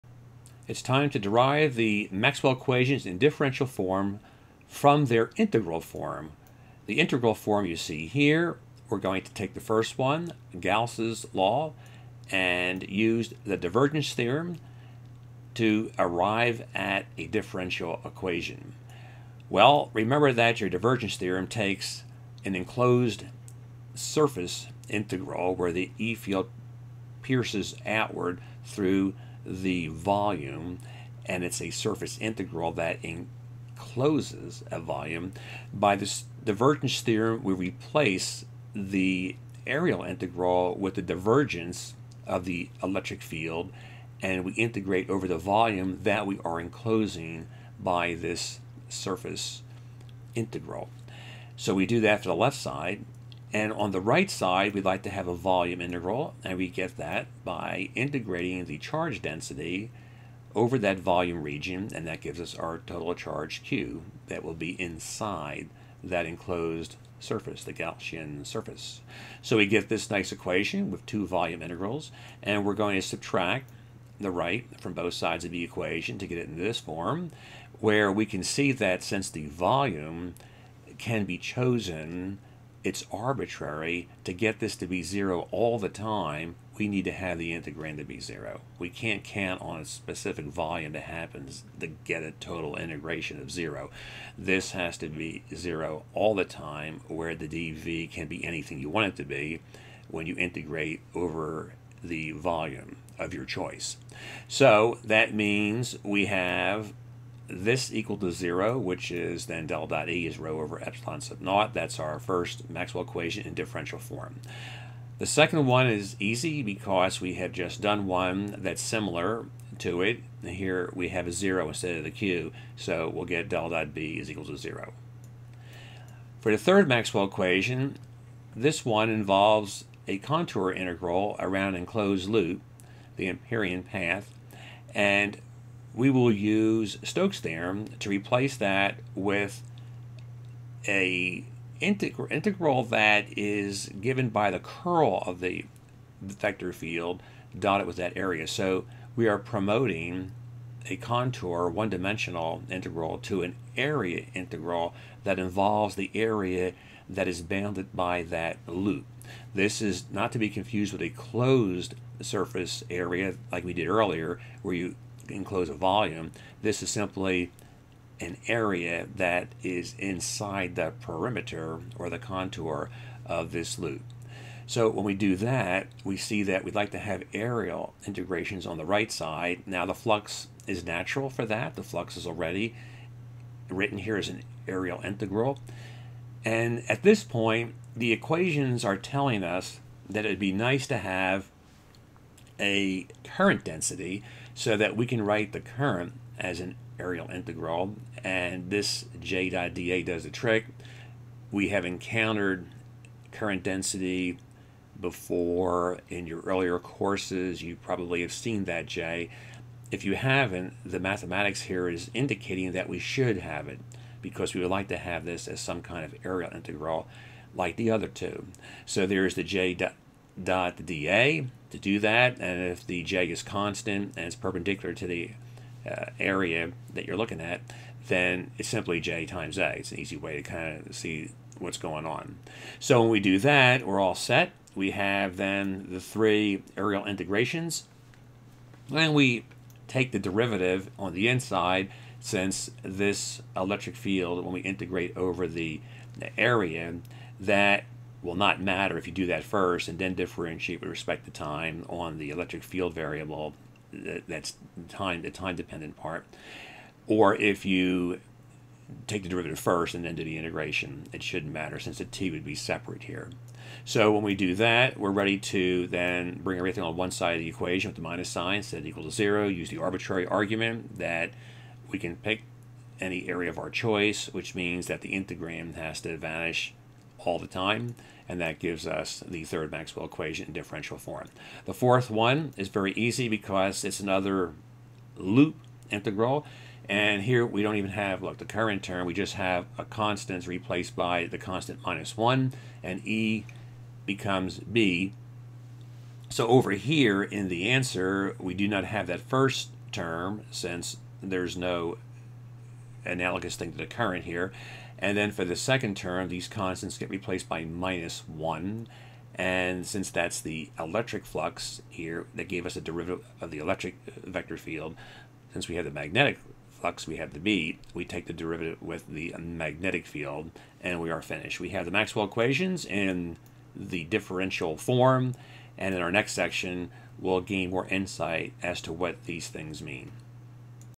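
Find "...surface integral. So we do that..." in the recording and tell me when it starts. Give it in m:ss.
0:48.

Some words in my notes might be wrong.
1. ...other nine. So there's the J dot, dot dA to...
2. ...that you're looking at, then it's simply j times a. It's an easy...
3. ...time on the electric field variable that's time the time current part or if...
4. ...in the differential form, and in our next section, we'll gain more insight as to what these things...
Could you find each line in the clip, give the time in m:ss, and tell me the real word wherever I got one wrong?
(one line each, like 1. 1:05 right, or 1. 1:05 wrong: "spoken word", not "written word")
1. 3:37 wrong: "two", not "nine"
2. 3:46 right
3. 4:11 wrong: "dependent", not "current"
4. 5:22 right.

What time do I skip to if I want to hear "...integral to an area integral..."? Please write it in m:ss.
2:32.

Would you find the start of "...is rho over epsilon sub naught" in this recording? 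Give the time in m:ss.
1:50.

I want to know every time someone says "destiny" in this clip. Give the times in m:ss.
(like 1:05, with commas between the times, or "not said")
not said.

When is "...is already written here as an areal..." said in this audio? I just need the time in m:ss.
3:02.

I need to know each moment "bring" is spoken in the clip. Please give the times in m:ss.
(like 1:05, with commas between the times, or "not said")
4:26.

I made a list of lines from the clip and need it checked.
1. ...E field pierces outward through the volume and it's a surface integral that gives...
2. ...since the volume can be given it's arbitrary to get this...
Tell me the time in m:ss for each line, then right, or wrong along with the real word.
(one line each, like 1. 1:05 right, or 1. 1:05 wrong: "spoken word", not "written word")
1. 0:25 wrong: "encloses", not "gives"
2. 1:19 wrong: "chosen", not "given".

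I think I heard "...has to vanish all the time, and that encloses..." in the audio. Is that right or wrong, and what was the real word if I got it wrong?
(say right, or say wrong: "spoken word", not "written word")
wrong: "gives", not "encloses".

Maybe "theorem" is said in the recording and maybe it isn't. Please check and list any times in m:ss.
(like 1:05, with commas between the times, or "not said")
0:14, 0:21, 0:37, 2:17.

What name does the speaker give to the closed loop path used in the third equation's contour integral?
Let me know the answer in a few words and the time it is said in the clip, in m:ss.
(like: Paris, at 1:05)
Amperian path, at 2:13.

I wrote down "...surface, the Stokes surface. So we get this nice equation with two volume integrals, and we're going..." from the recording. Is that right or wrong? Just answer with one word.
wrong.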